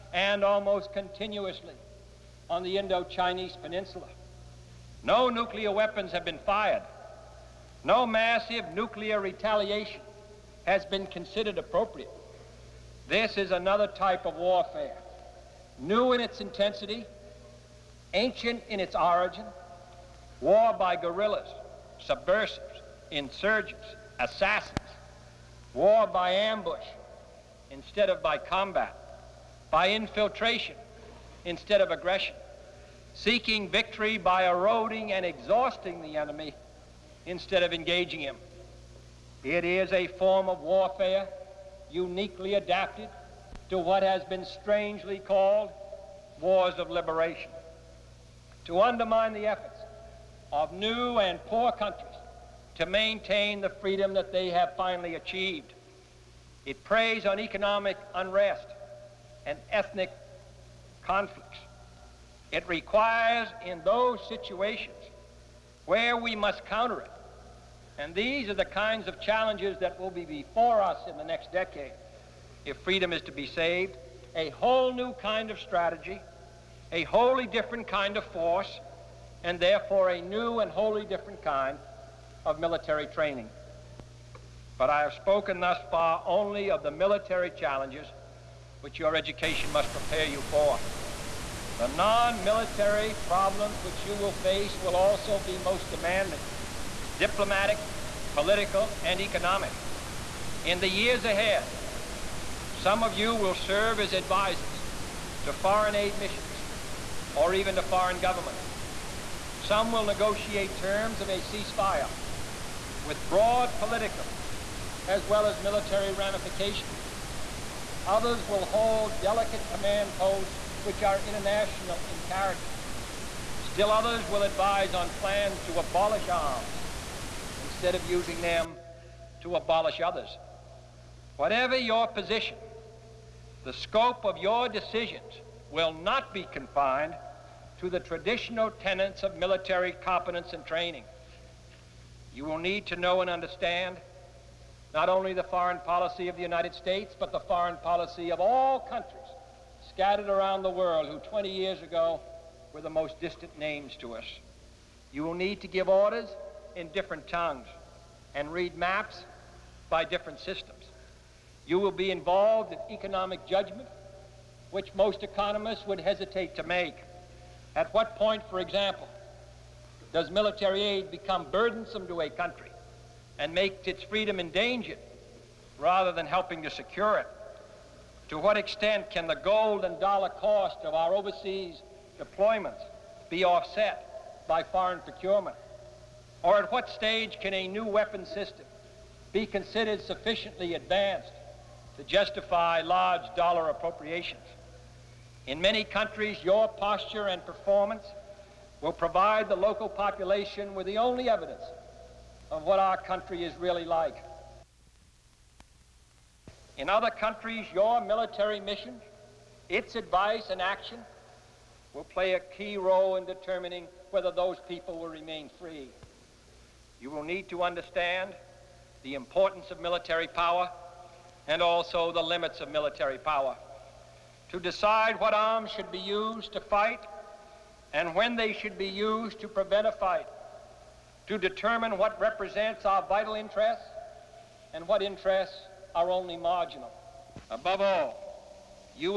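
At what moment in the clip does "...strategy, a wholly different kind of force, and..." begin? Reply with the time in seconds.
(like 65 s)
75 s.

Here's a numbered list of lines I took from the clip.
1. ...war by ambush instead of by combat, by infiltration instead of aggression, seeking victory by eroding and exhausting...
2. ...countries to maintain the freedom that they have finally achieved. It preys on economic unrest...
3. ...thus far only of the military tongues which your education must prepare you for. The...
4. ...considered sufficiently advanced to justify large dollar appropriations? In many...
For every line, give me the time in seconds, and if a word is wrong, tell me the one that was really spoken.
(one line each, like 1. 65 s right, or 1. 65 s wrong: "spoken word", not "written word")
1. 25 s right
2. 51 s right
3. 85 s wrong: "challenges", not "tongues"
4. 189 s right.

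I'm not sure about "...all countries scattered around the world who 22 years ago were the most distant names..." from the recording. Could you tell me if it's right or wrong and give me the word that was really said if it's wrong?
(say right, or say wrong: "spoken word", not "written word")
wrong: "20", not "22".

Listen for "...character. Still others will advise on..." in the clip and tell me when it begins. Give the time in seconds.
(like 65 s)
122 s.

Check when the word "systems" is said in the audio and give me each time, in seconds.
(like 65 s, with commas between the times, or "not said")
160 s, 188 s.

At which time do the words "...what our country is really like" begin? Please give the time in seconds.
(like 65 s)
202 s.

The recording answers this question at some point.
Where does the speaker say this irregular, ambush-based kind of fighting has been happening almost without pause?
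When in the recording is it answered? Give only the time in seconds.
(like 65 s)
2 s.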